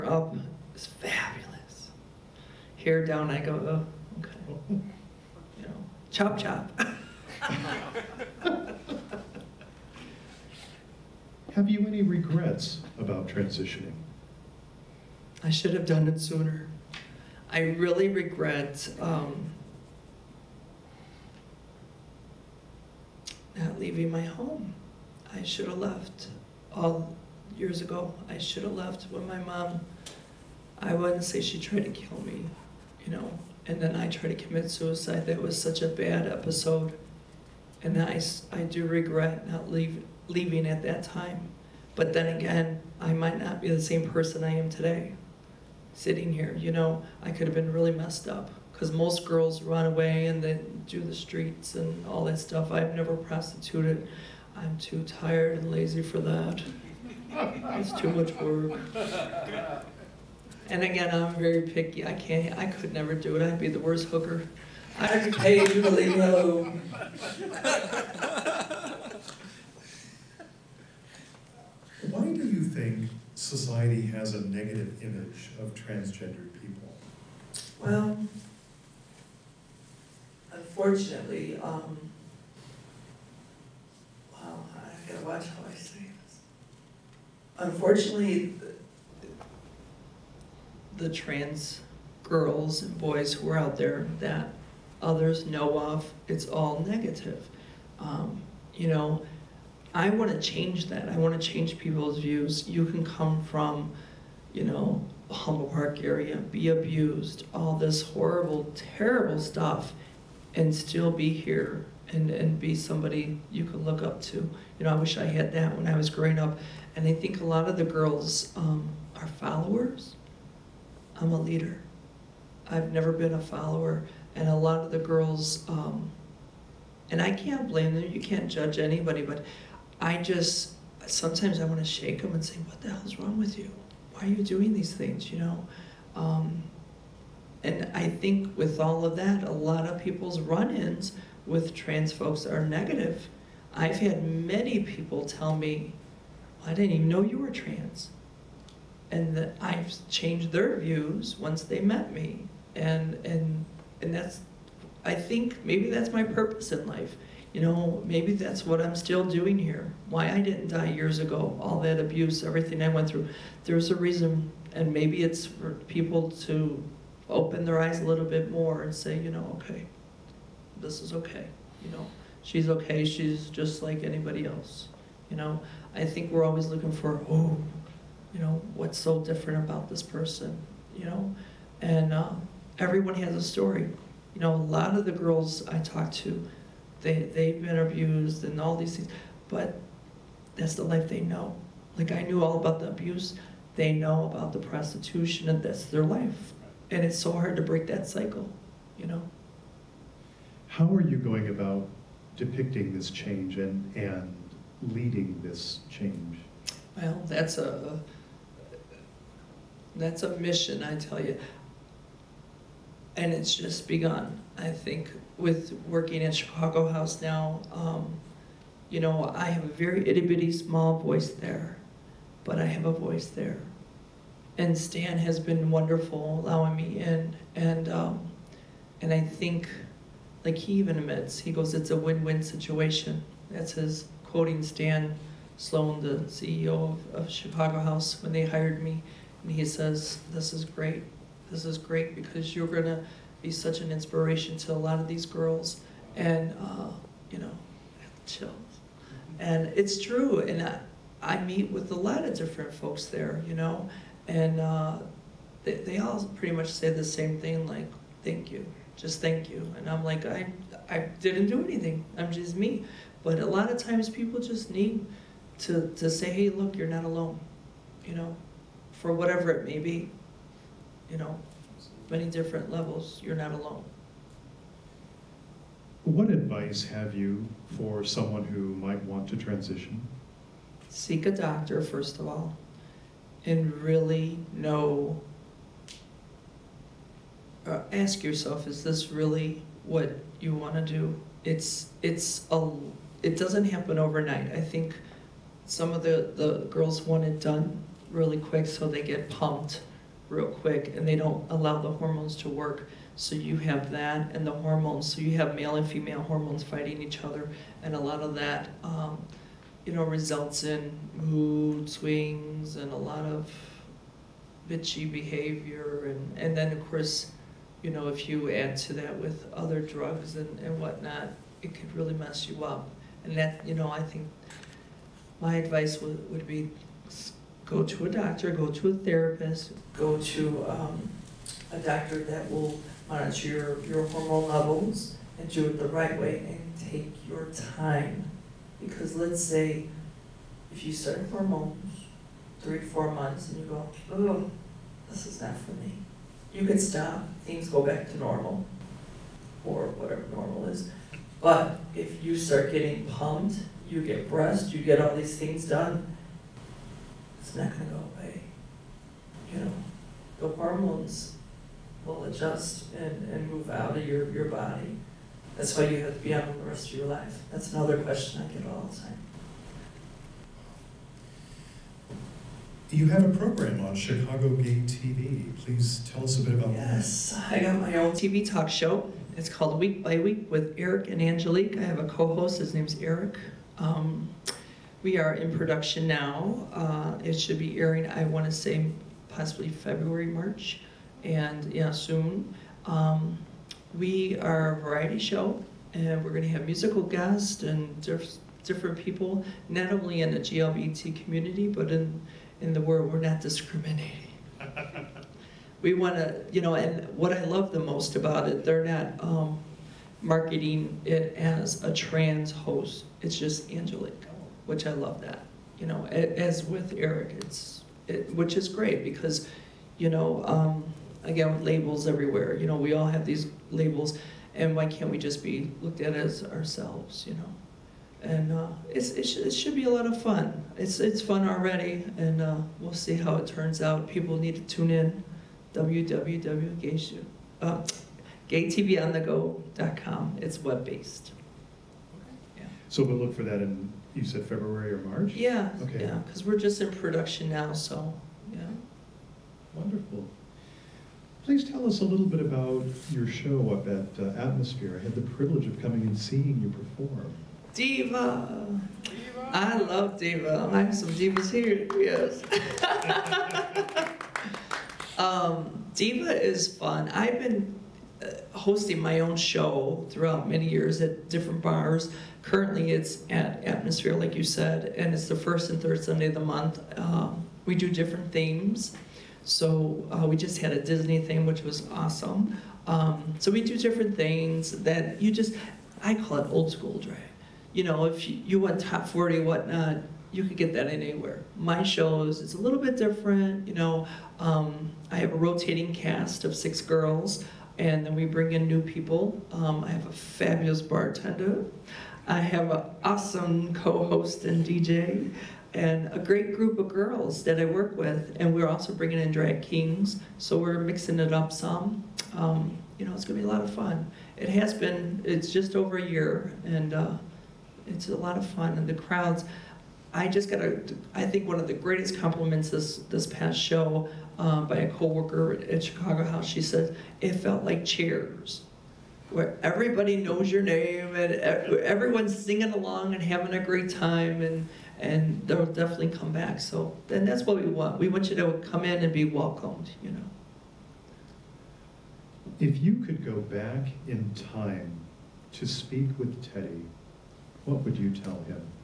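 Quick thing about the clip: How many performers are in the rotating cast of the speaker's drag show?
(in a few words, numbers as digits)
6.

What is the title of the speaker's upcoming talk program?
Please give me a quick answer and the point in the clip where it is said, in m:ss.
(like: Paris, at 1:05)
Week by Week with Eric and Angelique, at 6:19.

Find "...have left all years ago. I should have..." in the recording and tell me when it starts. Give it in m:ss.
0:25.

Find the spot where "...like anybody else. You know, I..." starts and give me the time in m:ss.
2:53.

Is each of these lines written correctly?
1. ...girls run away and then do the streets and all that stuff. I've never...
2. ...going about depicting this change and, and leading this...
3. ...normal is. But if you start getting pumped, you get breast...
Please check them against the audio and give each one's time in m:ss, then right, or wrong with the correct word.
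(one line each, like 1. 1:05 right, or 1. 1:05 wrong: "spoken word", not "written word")
1. 0:49 right
2. 3:21 right
3. 5:50 right.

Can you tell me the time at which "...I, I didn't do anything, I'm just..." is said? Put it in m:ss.
4:20.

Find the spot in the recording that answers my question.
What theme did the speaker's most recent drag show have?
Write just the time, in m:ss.
8:00.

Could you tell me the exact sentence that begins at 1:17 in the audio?
Well, unfortunately, um, well, I gotta watch how I say this.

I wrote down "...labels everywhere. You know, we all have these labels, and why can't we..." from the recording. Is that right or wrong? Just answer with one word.
right.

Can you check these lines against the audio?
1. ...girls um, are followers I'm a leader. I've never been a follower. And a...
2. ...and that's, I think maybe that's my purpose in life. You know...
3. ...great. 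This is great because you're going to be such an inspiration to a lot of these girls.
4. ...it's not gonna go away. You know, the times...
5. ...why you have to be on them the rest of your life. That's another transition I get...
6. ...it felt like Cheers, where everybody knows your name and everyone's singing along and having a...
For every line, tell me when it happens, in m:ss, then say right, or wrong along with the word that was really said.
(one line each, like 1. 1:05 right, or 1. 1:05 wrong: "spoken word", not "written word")
1. 1:57 right
2. 2:34 right
3. 4:00 right
4. 5:57 wrong: "hormones", not "times"
5. 6:05 wrong: "question", not "transition"
6. 8:47 right.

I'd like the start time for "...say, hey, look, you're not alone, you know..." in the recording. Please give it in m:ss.
4:26.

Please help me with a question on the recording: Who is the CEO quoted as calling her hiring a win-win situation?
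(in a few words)
Stan Sloan.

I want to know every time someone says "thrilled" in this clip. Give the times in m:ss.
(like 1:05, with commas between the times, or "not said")
not said.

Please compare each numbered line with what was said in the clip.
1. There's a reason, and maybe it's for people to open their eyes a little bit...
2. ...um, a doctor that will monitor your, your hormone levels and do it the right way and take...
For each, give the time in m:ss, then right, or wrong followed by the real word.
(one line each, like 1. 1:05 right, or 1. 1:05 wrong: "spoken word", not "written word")
1. 2:43 right
2. 5:30 right.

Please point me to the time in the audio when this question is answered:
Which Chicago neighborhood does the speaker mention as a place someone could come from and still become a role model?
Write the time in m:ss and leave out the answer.
1:45.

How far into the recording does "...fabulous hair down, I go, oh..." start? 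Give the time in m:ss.
0:00.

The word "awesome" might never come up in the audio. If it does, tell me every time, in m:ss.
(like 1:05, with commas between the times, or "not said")
8:01, 8:23.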